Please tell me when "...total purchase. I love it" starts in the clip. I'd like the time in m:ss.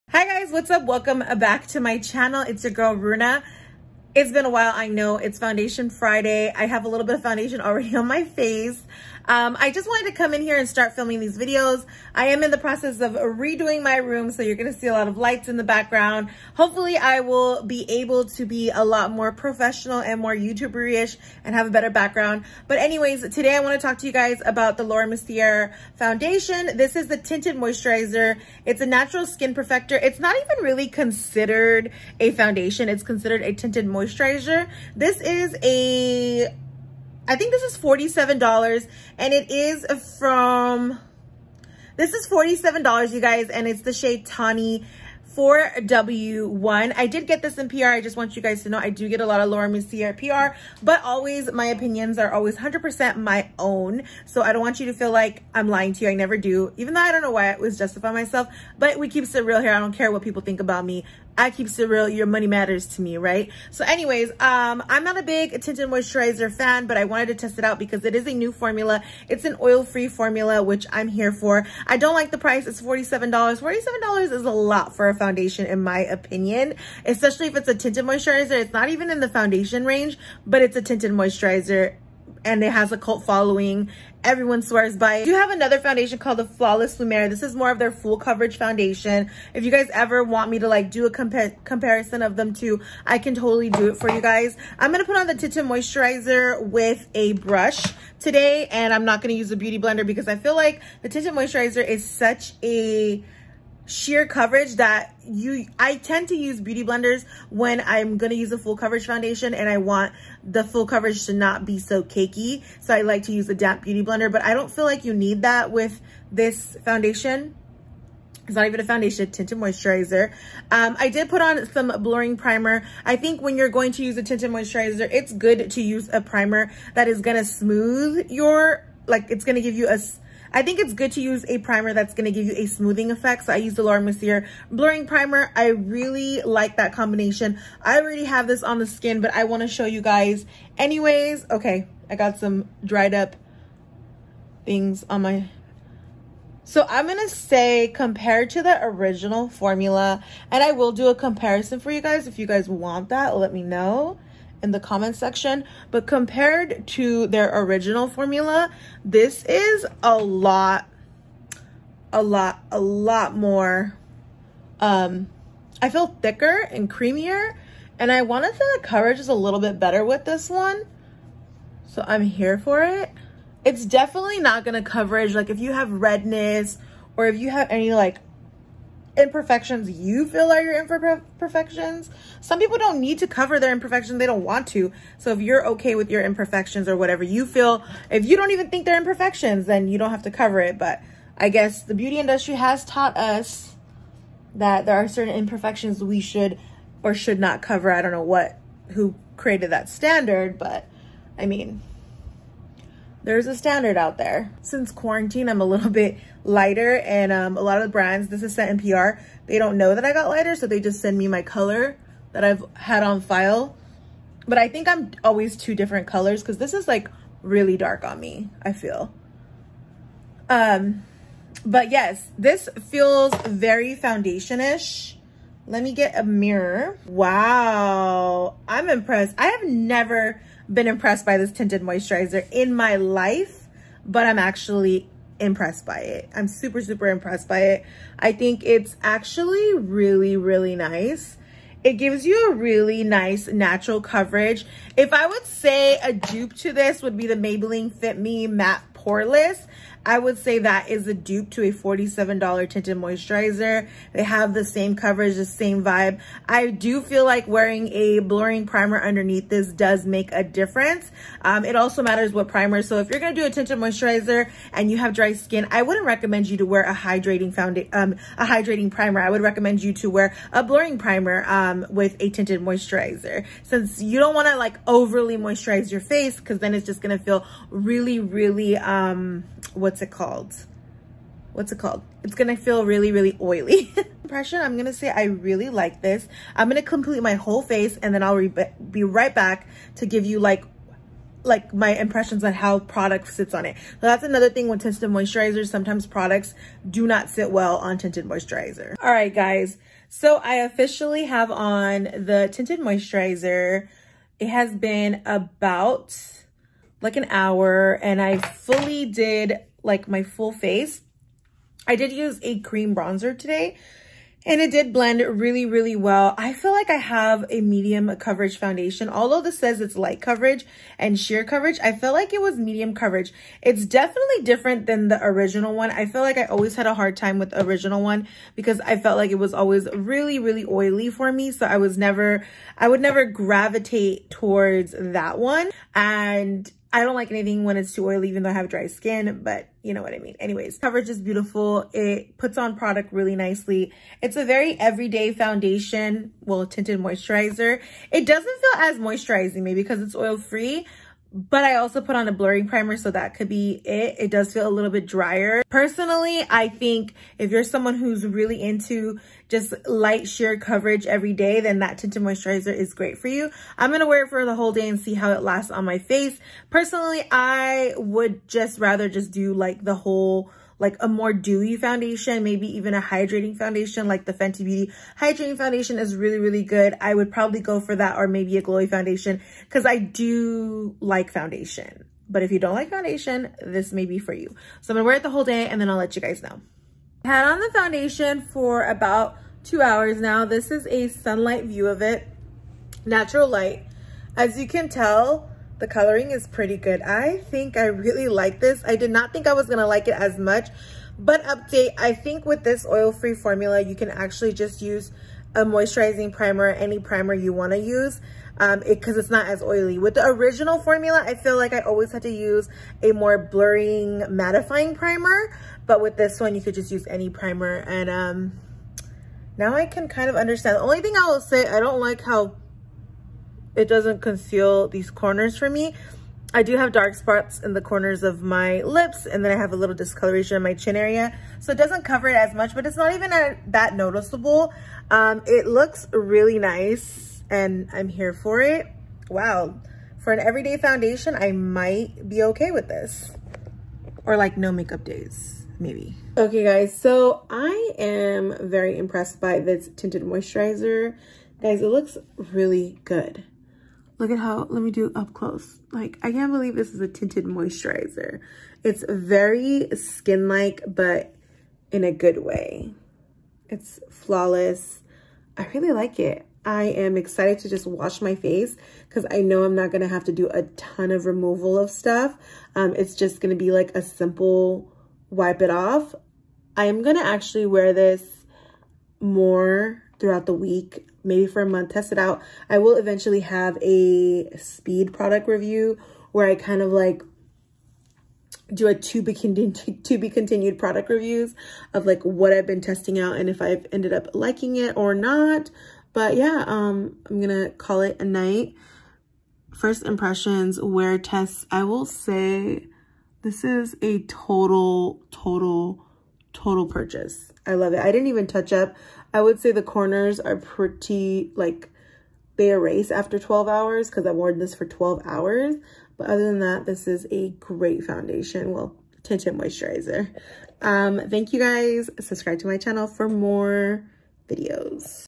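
8:26.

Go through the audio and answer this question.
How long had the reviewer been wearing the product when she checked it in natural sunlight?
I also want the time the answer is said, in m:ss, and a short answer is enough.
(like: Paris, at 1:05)
two hours, at 6:29.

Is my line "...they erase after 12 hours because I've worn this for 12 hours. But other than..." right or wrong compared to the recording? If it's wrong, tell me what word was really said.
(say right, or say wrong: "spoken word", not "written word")
right.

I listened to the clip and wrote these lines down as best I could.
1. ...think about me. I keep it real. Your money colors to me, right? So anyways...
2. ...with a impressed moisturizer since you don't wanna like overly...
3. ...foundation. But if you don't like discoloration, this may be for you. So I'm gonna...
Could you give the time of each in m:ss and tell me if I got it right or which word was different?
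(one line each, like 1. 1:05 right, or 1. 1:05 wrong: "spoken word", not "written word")
1. 1:00 wrong: "matters", not "colors"
2. 4:31 wrong: "tinted", not "impressed"
3. 6:21 wrong: "foundation", not "discoloration".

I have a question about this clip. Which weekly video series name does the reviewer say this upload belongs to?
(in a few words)
Foundation Friday.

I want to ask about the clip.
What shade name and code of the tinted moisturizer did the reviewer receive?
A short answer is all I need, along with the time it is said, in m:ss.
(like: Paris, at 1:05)
Tawny 4W1, at 0:44.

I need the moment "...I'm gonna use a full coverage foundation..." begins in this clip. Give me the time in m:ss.
1:47.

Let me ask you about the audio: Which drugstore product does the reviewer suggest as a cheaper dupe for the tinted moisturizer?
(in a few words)
Maybelline Fit Me Matte poreless.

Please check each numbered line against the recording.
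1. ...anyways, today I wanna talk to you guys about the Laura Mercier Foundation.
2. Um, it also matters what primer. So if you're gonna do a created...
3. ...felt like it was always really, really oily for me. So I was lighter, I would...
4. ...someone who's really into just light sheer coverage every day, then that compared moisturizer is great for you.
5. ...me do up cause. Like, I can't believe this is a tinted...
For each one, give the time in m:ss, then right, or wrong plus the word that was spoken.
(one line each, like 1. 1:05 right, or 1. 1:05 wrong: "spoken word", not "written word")
1. 0:22 right
2. 4:21 wrong: "tinted", not "created"
3. 5:28 wrong: "never", not "lighter"
4. 5:57 wrong: "tinted", not "compared"
5. 7:34 wrong: "close", not "cause".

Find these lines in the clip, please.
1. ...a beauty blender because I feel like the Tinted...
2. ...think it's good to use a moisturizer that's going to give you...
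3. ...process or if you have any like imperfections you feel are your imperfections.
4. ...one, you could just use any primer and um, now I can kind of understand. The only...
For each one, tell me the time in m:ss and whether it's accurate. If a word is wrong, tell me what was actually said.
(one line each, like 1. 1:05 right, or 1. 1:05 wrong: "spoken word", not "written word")
1. 1:39 right
2. 2:10 wrong: "primer", not "moisturizer"
3. 2:55 wrong: "redness", not "process"
4. 6:56 right.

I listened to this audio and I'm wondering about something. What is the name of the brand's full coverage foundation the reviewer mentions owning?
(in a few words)
Flawless Lumiere.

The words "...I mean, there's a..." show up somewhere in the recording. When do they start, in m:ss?
3:21.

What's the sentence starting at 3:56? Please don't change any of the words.
I'm super, super impressed by it.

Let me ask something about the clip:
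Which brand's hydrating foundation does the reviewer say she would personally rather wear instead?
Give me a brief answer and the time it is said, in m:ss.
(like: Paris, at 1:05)
Fenty Beauty, at 6:14.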